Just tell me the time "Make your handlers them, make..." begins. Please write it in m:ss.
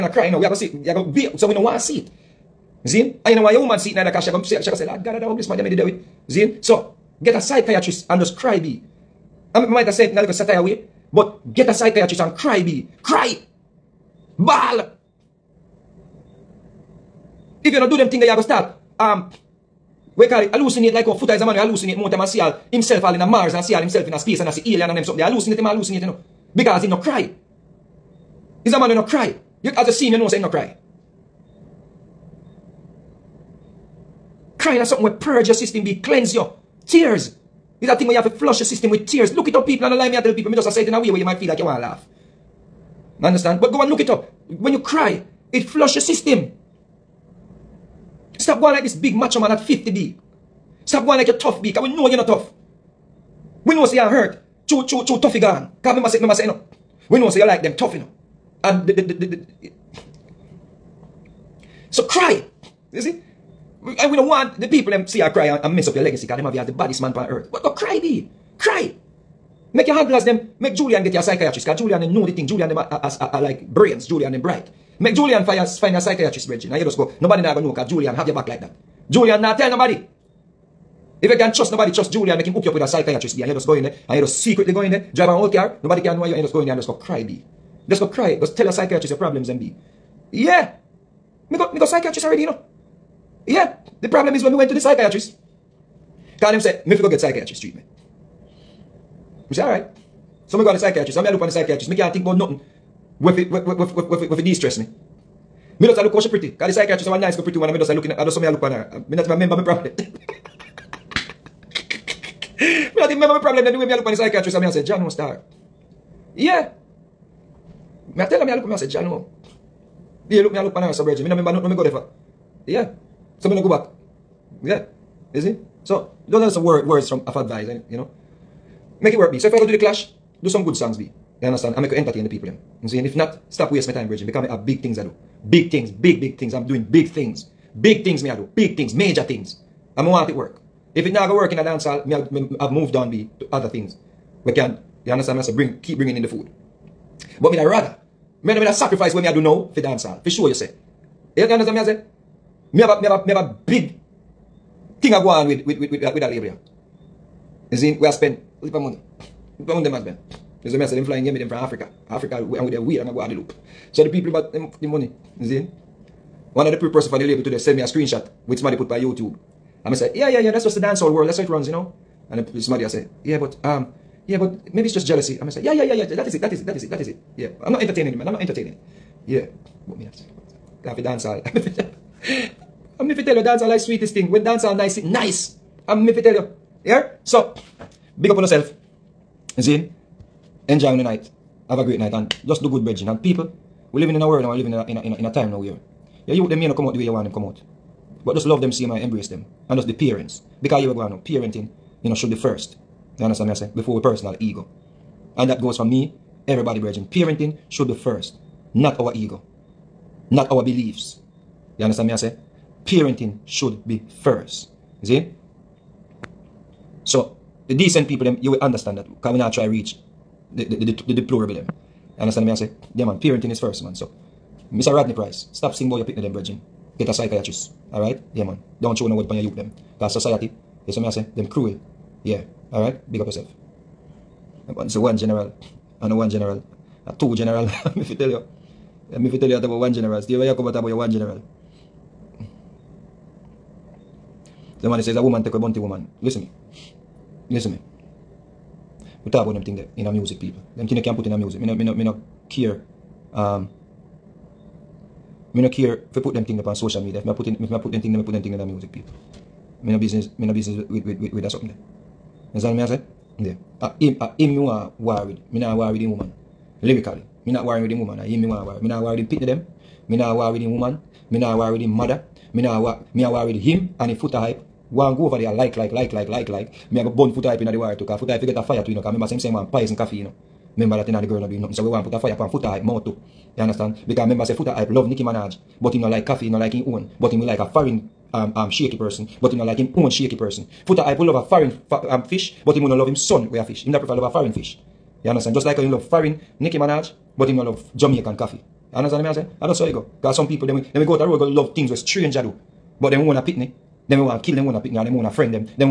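1:09.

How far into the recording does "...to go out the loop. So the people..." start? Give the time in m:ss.
2:43.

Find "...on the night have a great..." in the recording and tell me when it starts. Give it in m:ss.
3:10.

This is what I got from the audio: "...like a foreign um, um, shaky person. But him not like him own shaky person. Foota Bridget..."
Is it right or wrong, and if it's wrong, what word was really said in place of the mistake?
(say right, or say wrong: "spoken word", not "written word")
wrong: "Hype", not "Bridget".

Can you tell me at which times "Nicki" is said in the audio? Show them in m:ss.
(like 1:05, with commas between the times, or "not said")
4:45, 4:56.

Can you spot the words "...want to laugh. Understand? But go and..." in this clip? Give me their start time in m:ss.
0:41.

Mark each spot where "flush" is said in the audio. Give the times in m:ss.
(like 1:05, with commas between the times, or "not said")
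0:38, 0:45.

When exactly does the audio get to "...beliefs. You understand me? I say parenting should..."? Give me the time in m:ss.
3:30.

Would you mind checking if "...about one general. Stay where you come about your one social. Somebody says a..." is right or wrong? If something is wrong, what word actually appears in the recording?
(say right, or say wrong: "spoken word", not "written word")
wrong: "general", not "social".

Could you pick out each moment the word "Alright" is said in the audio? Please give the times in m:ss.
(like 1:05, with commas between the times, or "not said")
3:47, 3:52.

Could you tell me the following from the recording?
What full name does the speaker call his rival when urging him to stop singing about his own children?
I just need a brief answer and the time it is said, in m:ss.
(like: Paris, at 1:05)
Rodney Price, at 3:44.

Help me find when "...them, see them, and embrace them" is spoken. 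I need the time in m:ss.
3:18.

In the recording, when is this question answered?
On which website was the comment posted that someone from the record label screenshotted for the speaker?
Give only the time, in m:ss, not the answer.
2:49.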